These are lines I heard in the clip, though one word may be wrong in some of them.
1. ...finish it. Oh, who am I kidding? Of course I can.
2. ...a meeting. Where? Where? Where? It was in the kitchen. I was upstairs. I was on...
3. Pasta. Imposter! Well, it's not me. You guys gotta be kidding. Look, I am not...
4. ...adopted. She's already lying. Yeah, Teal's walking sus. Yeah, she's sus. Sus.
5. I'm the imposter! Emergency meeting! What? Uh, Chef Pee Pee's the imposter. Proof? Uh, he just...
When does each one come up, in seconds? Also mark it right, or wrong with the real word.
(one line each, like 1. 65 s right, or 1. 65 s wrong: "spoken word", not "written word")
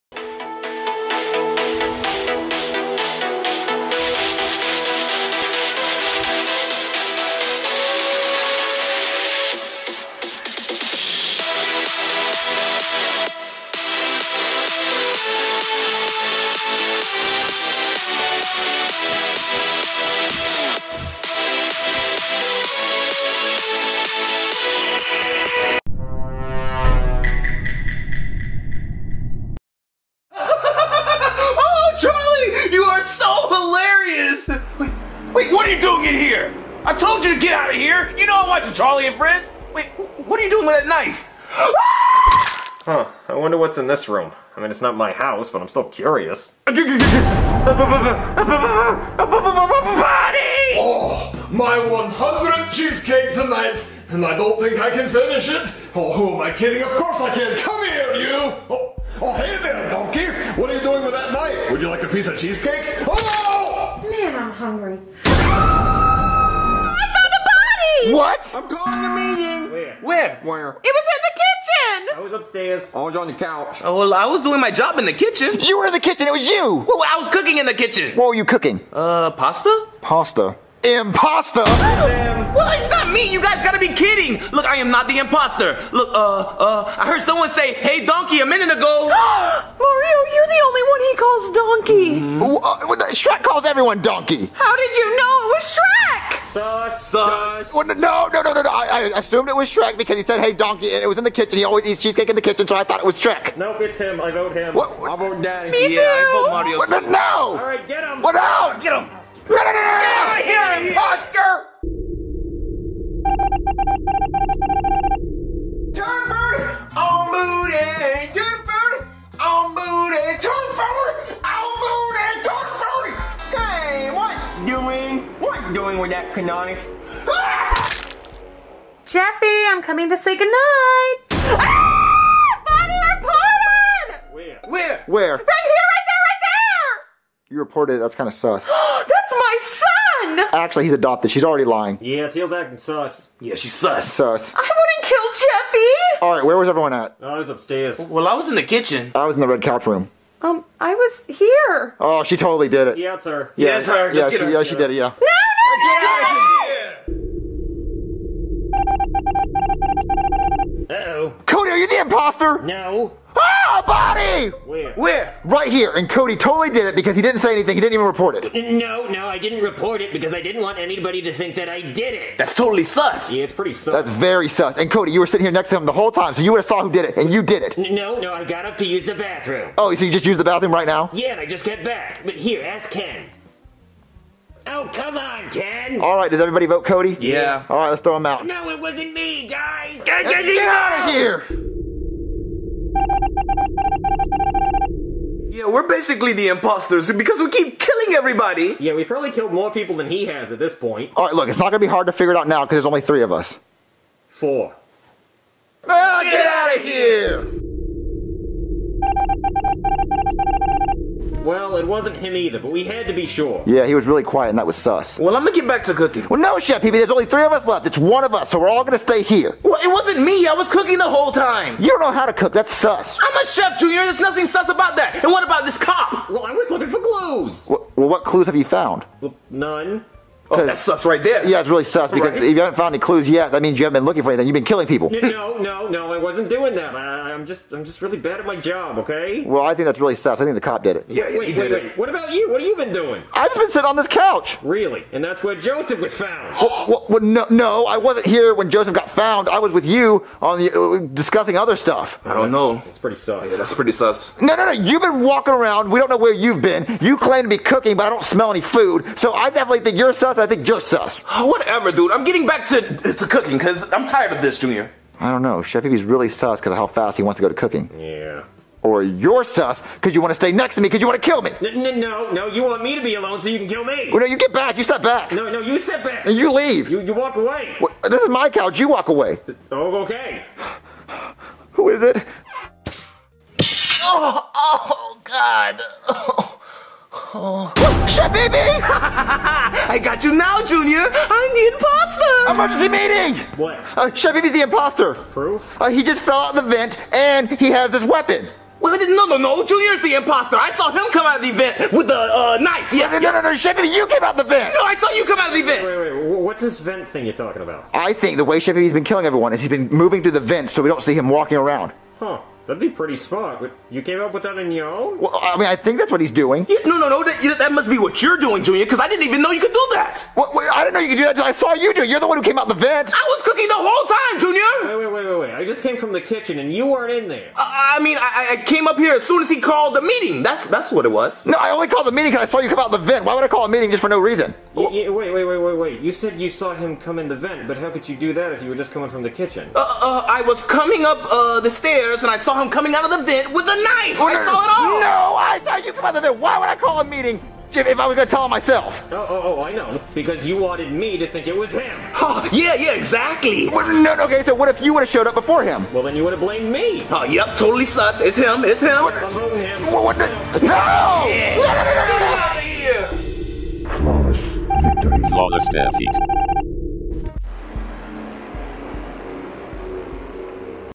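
1. 55 s right
2. 69 s right
3. 80 s right
4. 140 s wrong: "acting", not "walking"
5. 291 s right.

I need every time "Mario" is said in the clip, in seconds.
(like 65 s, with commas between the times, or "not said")
89 s, 106 s.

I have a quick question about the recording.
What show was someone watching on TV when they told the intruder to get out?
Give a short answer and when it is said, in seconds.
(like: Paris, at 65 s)
Charlie and Friends, at 38 s.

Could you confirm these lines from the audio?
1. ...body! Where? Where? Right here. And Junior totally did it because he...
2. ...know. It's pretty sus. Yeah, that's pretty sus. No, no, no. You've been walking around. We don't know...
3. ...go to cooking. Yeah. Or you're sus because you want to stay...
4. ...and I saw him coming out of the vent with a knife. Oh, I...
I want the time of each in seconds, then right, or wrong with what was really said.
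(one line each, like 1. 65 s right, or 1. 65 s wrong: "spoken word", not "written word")
1. 163 s wrong: "Cody", not "Junior"
2. 252 s right
3. 267 s right
4. 342 s right.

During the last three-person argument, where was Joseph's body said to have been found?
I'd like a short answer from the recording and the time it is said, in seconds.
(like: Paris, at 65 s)
The couch, at 243 s.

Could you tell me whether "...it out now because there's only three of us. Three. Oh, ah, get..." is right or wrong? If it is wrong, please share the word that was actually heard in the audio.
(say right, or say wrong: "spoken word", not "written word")
wrong: "Four", not "Three".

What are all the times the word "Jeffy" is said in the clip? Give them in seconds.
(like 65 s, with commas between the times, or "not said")
129 s, 145 s.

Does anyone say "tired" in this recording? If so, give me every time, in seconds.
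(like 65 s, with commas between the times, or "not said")
264 s.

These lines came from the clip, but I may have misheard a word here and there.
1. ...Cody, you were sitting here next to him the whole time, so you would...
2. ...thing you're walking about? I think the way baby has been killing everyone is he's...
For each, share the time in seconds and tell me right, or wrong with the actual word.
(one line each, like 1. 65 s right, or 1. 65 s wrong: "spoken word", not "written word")
1. 174 s right
2. 307 s wrong: "talking", not "walking".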